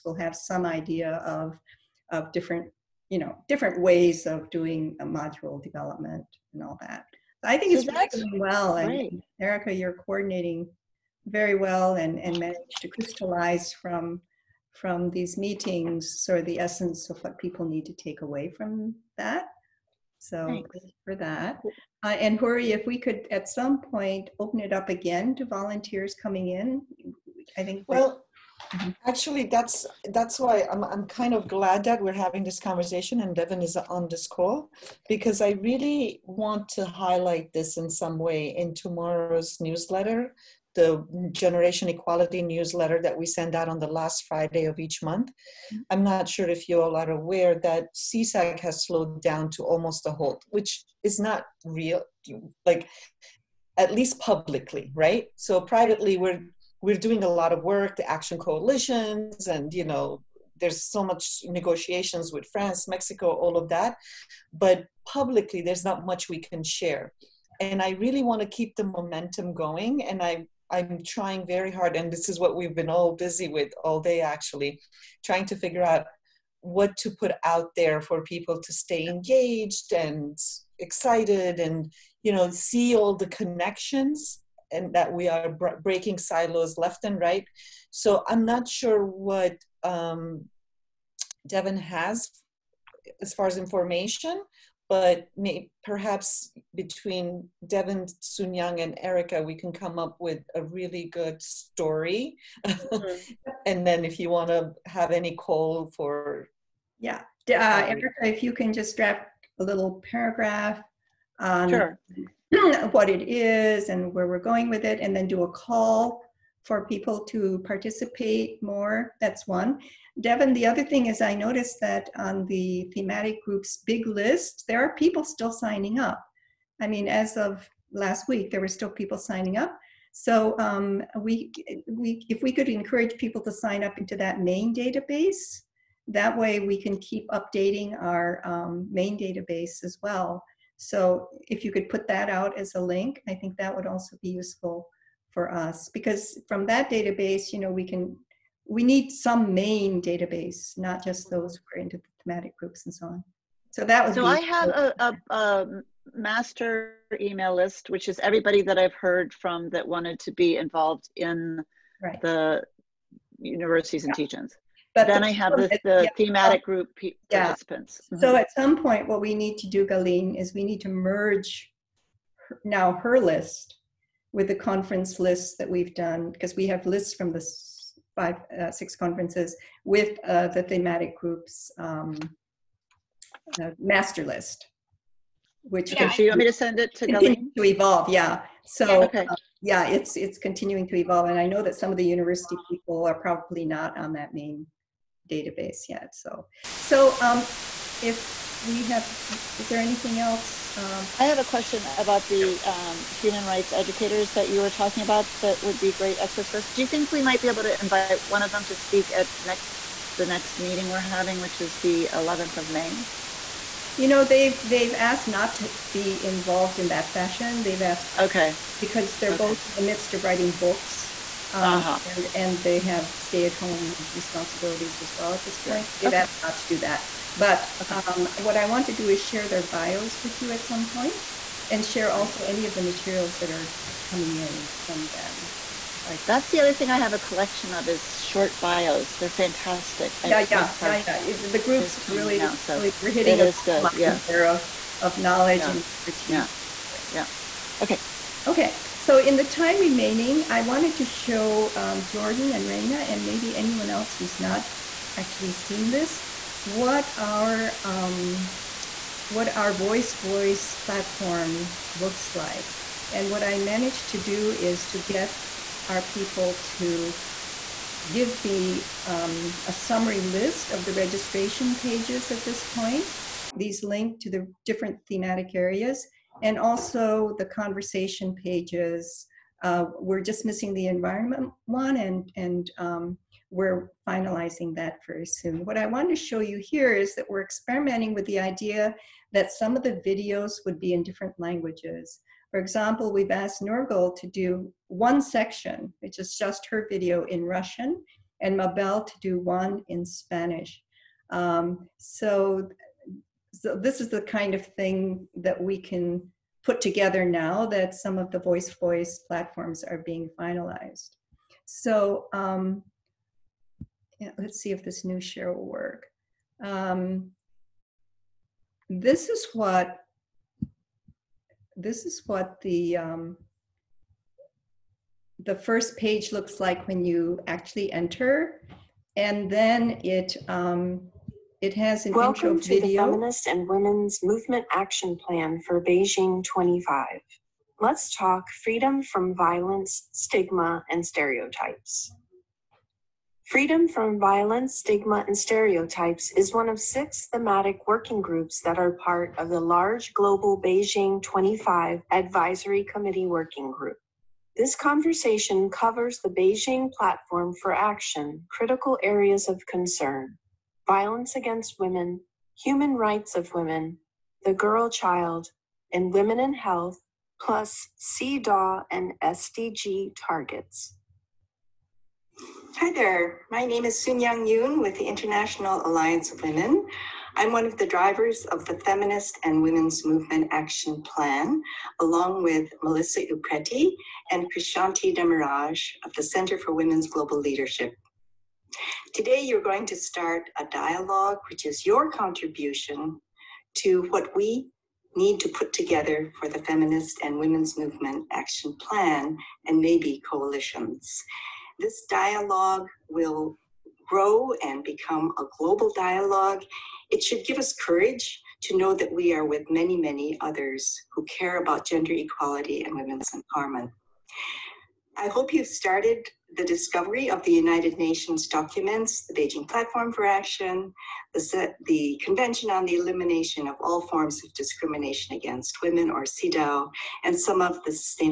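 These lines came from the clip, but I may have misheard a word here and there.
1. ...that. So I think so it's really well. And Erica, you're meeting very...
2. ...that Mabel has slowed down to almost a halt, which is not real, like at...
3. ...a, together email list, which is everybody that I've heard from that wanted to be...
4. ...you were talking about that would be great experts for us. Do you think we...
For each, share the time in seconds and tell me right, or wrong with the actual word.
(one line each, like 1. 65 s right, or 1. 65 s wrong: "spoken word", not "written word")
1. 6 s wrong: "coordinating", not "meeting"
2. 47 s wrong: "CSAC", not "Mabel"
3. 155 s wrong: "master", not "together"
4. 204 s right.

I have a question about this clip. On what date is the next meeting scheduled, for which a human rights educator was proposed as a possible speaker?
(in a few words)
11th of May.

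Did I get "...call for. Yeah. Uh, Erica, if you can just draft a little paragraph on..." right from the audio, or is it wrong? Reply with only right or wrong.
right.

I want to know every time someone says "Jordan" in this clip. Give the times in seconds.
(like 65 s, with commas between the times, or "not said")
252 s.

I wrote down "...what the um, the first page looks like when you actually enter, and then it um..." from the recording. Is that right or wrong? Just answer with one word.
right.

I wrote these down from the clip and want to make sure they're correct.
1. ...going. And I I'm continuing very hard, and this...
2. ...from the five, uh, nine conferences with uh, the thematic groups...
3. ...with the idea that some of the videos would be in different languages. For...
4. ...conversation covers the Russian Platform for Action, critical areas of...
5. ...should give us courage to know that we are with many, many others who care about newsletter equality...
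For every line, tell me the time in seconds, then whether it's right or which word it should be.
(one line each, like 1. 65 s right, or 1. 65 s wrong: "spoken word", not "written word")
1. 69 s wrong: "trying", not "continuing"
2. 177 s wrong: "six", not "nine"
3. 288 s right
4. 354 s wrong: "Beijing", not "Russian"
5. 407 s wrong: "gender", not "newsletter".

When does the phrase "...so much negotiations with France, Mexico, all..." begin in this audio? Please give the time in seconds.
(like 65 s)
60 s.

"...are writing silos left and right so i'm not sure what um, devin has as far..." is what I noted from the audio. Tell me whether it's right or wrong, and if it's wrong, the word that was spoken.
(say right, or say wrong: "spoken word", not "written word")
wrong: "breaking", not "writing".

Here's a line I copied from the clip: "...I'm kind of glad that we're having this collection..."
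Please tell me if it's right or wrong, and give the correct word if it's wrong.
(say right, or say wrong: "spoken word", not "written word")
wrong: "conversation", not "collection".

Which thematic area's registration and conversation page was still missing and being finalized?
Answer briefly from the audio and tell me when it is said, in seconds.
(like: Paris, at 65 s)
Environment, at 280 s.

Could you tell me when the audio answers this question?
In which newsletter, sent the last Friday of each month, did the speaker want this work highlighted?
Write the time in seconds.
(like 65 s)
41 s.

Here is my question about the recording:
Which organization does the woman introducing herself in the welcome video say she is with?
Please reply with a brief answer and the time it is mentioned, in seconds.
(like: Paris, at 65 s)
International Alliance of Women, at 375 s.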